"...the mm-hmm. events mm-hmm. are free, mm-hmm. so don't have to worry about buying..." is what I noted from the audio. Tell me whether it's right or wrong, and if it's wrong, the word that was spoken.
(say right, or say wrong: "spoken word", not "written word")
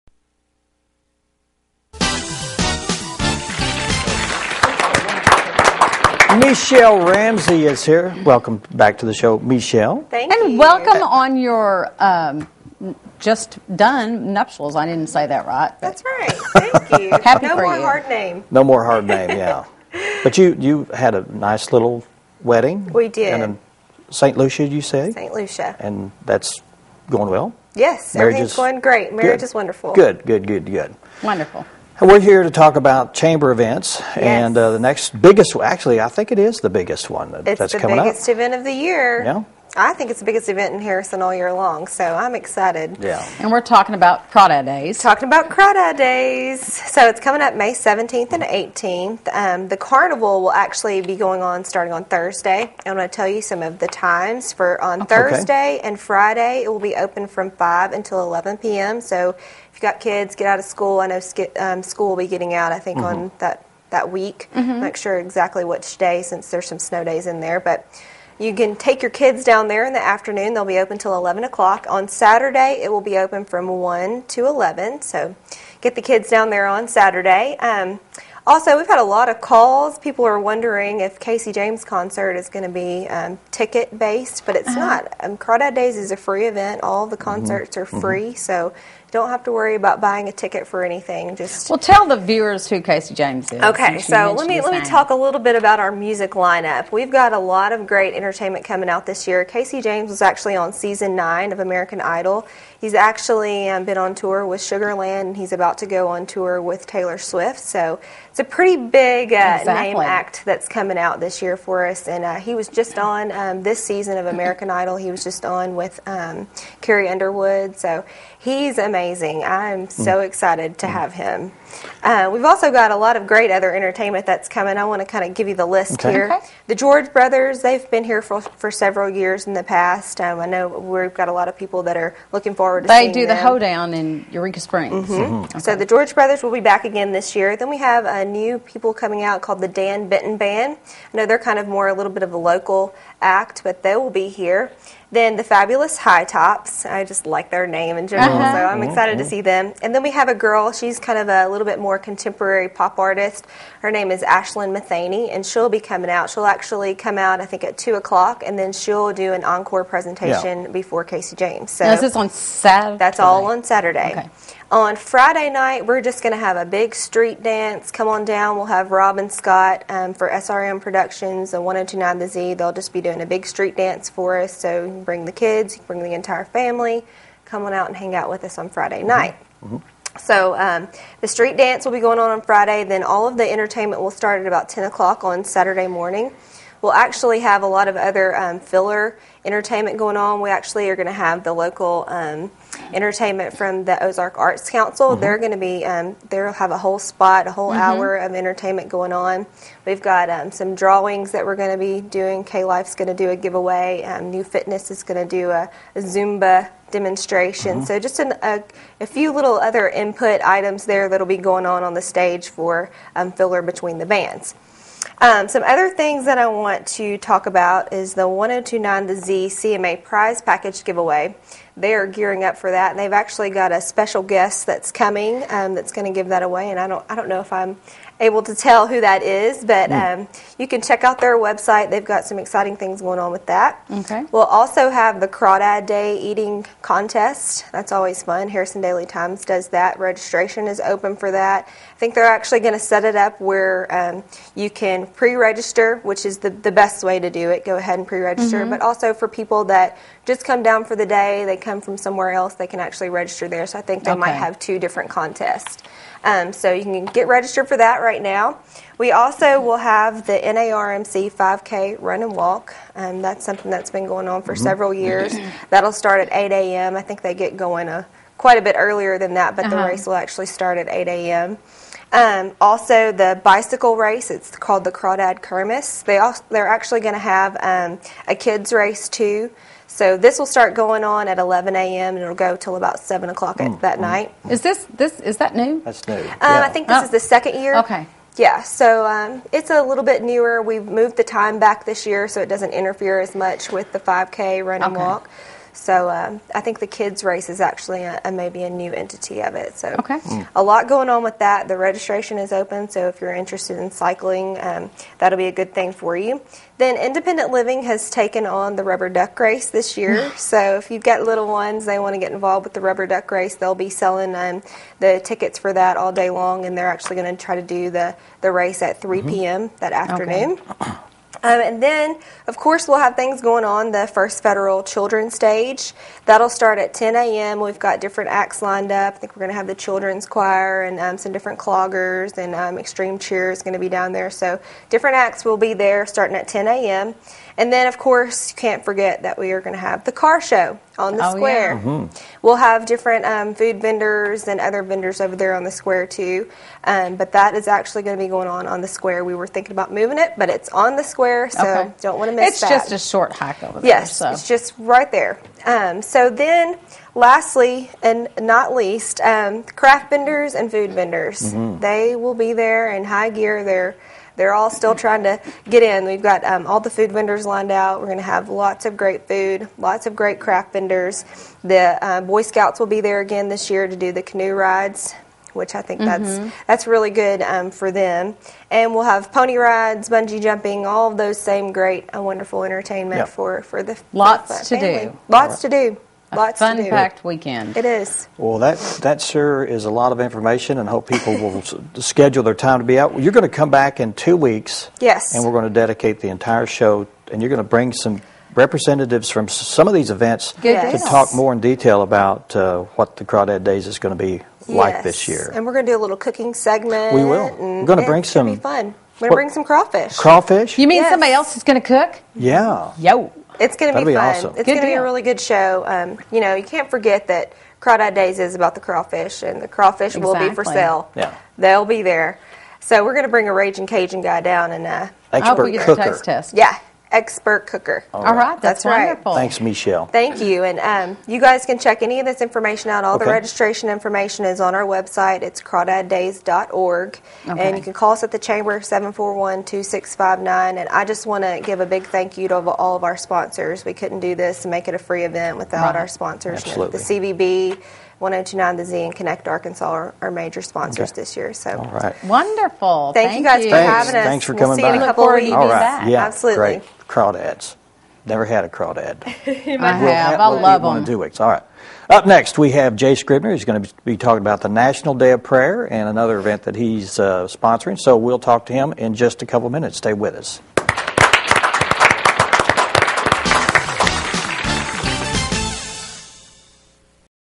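wrong: "concerts", not "events".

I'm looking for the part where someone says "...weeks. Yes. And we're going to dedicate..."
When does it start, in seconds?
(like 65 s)
394 s.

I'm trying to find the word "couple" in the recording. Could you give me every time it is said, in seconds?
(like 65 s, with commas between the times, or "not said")
455 s, 469 s.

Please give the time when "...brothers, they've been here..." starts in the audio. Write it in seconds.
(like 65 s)
127 s.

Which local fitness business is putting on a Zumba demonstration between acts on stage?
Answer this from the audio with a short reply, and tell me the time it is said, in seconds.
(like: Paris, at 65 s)
New Fitness, at 204 s.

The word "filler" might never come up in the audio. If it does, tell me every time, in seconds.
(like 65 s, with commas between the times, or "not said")
188 s, 213 s.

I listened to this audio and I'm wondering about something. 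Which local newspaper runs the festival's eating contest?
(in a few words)
Harrison Daily Times.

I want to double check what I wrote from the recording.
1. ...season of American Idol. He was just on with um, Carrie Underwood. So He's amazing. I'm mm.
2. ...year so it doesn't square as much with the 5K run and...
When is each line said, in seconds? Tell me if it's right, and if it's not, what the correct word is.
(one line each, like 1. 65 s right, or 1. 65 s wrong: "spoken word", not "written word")
1. 113 s right
2. 292 s wrong: "interfere", not "square".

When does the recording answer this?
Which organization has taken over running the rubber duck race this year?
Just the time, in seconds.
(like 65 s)
306 s.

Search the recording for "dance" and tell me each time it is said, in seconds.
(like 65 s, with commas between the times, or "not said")
167 s, 173 s, 181 s.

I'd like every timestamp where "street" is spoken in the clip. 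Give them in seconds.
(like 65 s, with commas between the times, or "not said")
166 s, 173 s, 181 s.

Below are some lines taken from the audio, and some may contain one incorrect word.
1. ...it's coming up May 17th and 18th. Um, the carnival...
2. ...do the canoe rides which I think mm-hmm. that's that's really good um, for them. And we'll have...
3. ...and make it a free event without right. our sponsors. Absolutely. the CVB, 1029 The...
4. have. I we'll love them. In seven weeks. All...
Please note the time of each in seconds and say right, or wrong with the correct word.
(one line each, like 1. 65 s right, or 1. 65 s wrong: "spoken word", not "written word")
1. 47 s right
2. 373 s right
3. 444 s right
4. 460 s wrong: "two", not "seven".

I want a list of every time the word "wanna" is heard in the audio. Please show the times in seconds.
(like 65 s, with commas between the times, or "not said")
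not said.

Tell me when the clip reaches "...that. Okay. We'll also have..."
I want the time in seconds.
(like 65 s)
233 s.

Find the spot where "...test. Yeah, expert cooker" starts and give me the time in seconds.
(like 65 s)
426 s.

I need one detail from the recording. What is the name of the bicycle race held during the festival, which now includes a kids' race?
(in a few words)
Crawdad Kermis.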